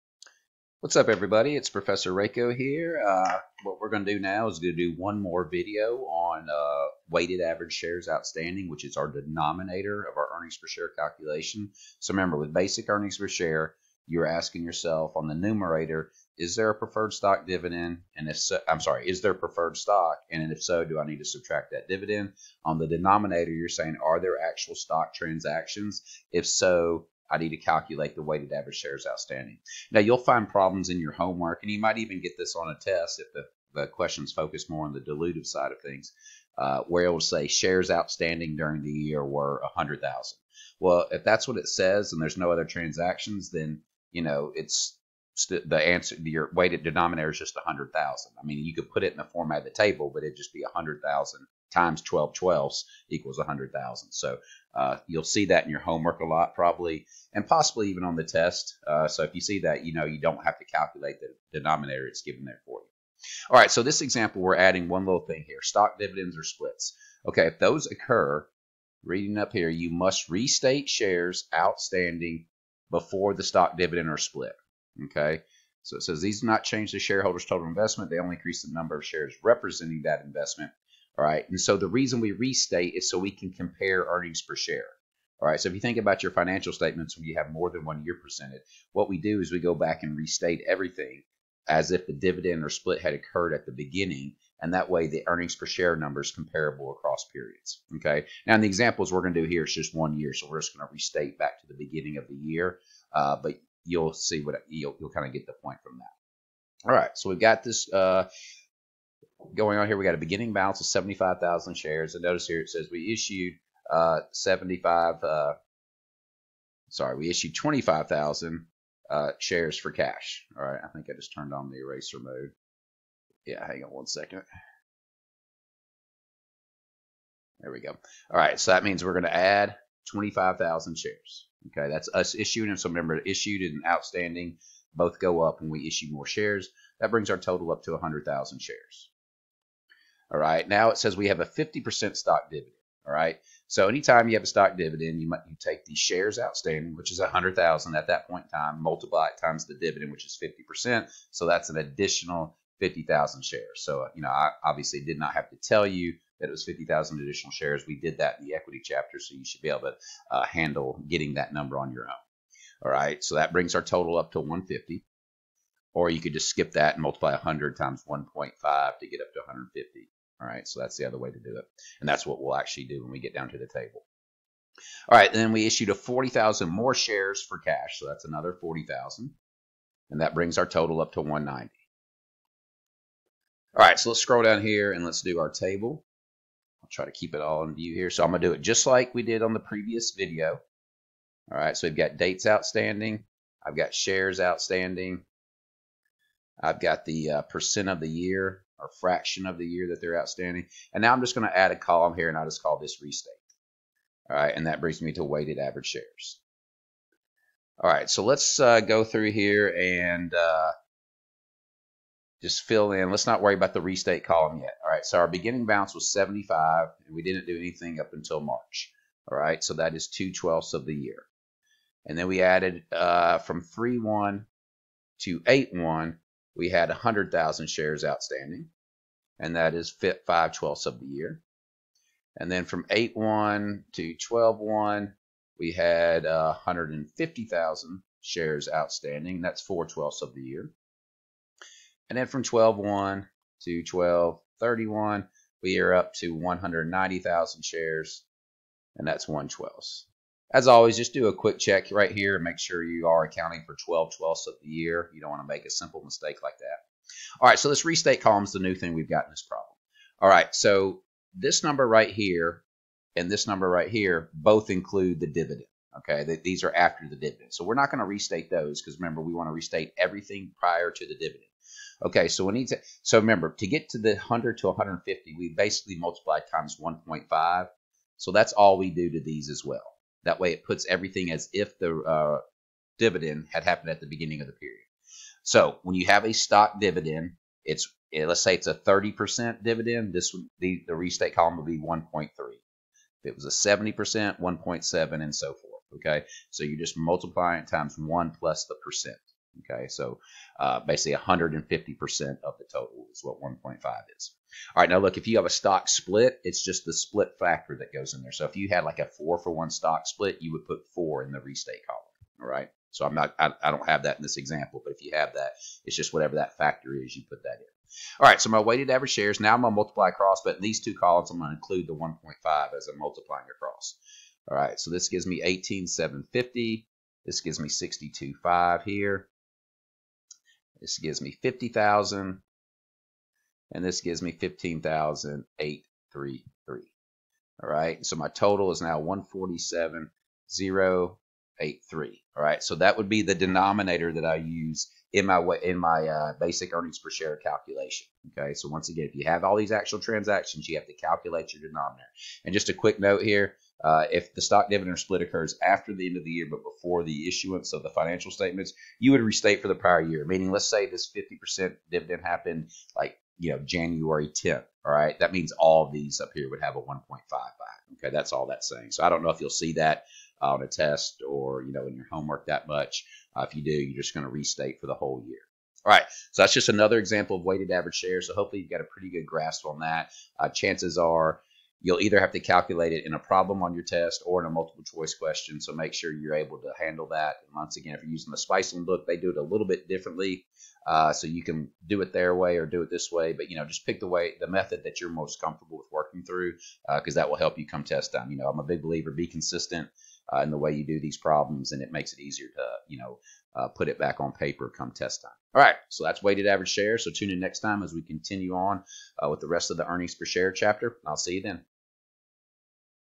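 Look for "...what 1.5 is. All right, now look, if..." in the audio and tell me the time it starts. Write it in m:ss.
5:03.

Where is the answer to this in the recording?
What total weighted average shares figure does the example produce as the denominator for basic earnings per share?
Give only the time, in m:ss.
5:38.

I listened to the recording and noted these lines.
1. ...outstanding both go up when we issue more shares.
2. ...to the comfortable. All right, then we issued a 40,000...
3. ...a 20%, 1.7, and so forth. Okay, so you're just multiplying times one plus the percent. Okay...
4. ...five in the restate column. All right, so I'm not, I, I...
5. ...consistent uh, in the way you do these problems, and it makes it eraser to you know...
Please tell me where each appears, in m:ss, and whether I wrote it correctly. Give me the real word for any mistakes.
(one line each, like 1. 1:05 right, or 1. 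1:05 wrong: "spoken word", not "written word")
1. 2:13 right
2. 2:53 wrong: "table", not "comfortable"
3. 4:53 wrong: "70", not "20"
4. 5:10 wrong: "four", not "five"
5. 6:39 wrong: "easier", not "eraser".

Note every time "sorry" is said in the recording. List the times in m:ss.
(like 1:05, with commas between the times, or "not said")
0:18, 1:56.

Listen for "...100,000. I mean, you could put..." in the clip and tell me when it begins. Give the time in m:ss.
0:47.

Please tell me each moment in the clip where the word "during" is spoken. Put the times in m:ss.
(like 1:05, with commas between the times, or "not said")
0:38.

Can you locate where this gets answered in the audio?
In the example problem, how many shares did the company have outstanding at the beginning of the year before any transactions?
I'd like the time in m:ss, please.
1:50.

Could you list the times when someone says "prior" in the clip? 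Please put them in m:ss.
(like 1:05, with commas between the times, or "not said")
4:30, 5:59.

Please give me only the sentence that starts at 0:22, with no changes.
On the denominator, you're saying, are there actual stock transactions?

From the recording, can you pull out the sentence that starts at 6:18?
So hopefully you've got a pretty good grasp on that.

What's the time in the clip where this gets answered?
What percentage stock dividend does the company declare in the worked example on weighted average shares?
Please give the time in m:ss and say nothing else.
2:21.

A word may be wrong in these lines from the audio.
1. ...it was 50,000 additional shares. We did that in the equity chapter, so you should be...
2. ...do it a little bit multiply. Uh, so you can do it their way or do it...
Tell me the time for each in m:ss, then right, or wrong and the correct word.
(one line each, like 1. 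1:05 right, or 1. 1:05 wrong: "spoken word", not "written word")
1. 2:36 right
2. 6:29 wrong: "differently", not "multiply".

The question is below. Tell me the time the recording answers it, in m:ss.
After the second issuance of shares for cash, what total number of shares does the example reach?
3:01.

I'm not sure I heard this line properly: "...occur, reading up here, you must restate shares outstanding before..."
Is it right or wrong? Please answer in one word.
right.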